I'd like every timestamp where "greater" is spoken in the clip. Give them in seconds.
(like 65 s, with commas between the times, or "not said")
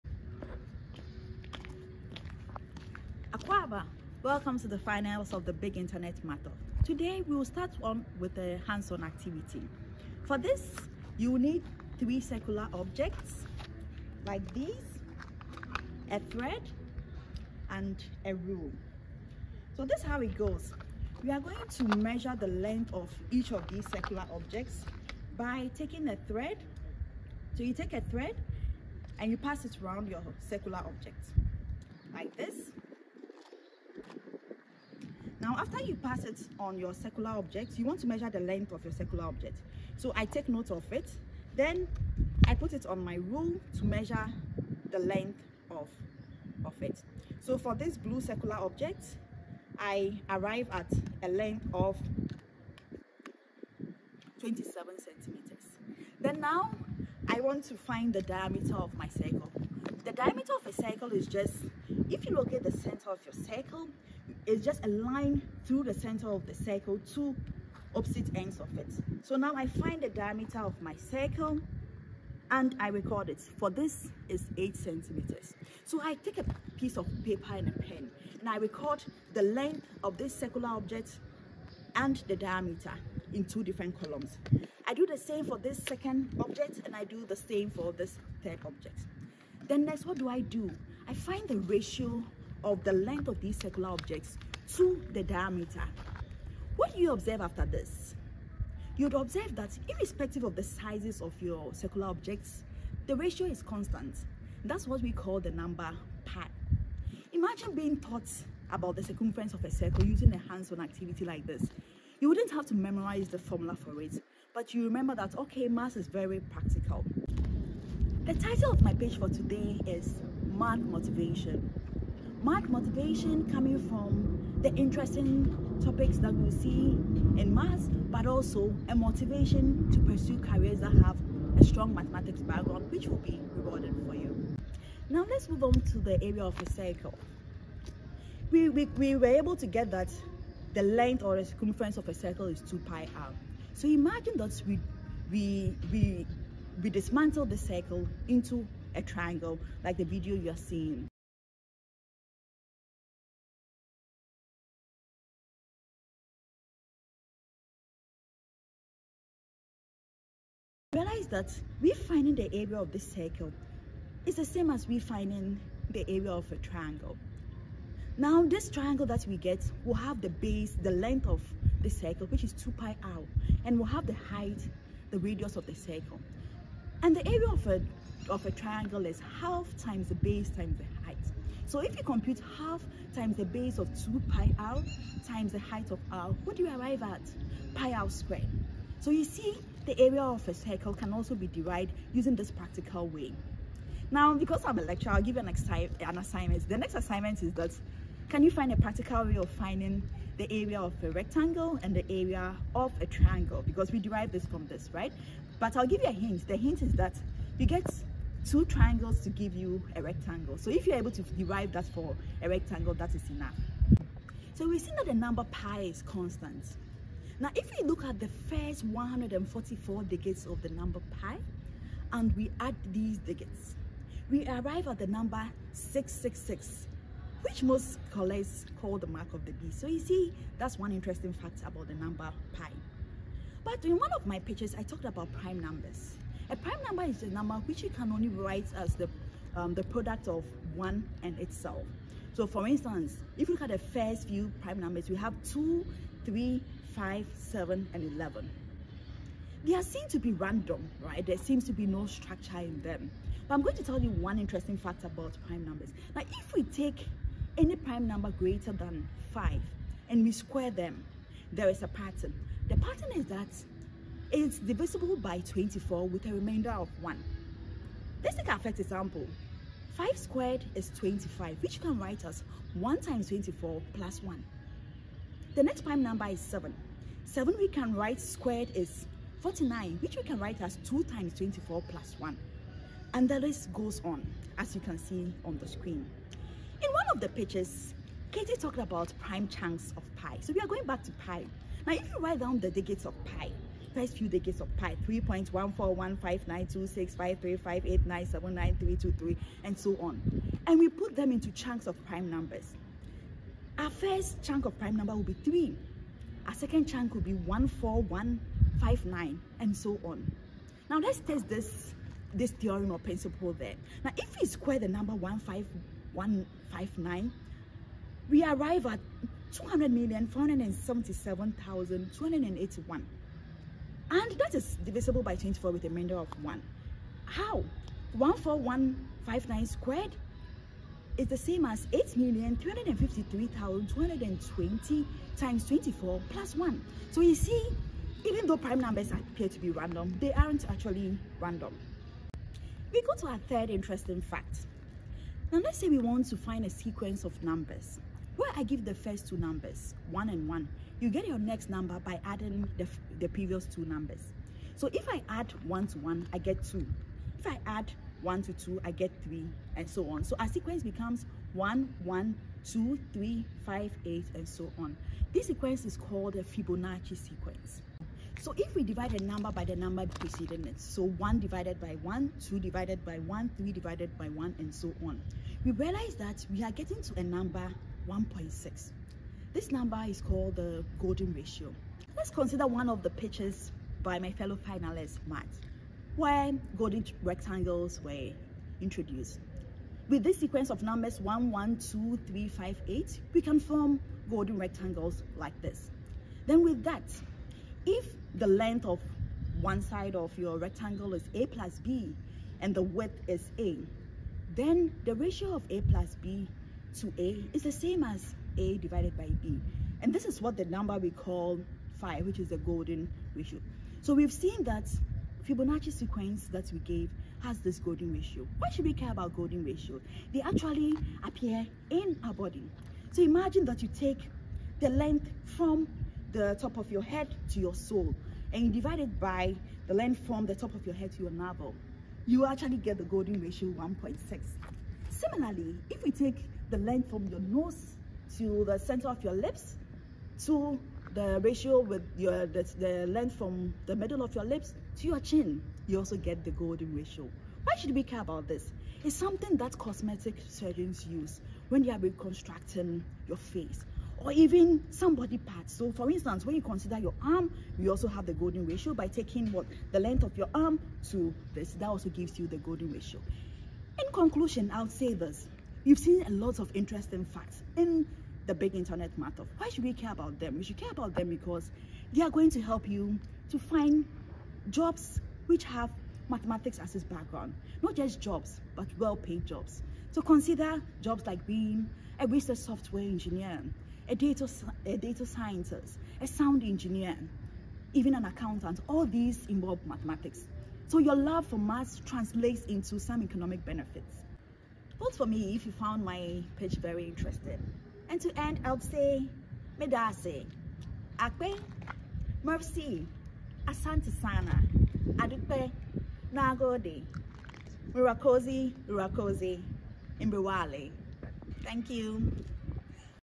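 258 s.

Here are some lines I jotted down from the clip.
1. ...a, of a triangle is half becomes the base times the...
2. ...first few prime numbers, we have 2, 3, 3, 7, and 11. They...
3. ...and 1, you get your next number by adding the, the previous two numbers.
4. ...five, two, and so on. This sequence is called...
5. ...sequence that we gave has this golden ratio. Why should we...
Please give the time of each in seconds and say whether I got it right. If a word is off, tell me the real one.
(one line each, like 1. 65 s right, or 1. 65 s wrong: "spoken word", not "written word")
1. 177 s wrong: "times", not "becomes"
2. 243 s wrong: "5", not "3"
3. 350 s right
4. 363 s wrong: "eight", not "two"
5. 415 s right.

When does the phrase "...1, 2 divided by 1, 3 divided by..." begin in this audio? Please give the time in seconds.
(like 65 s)
372 s.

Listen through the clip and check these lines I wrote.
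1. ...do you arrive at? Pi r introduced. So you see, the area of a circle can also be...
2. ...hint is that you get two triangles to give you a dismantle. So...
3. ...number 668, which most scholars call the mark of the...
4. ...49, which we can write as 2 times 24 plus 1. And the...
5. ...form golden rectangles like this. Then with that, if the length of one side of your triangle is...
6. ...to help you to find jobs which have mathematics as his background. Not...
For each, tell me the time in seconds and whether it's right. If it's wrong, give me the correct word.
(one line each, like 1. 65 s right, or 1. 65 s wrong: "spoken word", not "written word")
1. 186 s wrong: "squared", not "introduced"
2. 206 s wrong: "rectangle", not "dismantle"
3. 225 s wrong: "666", not "668"
4. 279 s right
5. 393 s wrong: "rectangle", not "triangle"
6. 472 s right.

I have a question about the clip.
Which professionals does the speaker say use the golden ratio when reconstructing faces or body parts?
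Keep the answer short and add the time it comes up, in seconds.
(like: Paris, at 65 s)
Cosmetic surgeons, at 449 s.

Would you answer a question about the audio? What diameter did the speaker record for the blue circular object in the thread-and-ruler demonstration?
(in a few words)
8 centimeters.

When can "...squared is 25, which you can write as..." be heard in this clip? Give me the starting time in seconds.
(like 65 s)
270 s.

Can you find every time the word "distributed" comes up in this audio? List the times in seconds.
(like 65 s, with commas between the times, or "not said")
not said.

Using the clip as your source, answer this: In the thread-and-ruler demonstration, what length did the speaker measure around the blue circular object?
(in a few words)
27 centimeters.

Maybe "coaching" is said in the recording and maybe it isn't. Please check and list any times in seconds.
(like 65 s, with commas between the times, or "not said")
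not said.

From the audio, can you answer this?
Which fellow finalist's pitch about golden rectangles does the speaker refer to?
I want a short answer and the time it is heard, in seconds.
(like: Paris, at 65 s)
Matt, at 385 s.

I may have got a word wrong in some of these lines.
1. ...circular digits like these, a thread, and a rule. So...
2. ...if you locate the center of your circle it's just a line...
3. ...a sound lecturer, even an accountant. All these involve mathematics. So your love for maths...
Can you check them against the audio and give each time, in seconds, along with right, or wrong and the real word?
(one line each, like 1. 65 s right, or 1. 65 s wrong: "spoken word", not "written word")
1. 12 s wrong: "objects", not "digits"
2. 62 s right
3. 486 s wrong: "engineer", not "lecturer".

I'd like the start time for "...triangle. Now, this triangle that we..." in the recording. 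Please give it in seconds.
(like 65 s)
166 s.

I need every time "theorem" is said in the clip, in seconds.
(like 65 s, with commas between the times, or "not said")
312 s.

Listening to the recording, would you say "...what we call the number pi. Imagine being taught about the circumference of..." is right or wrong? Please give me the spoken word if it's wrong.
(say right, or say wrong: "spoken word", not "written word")
right.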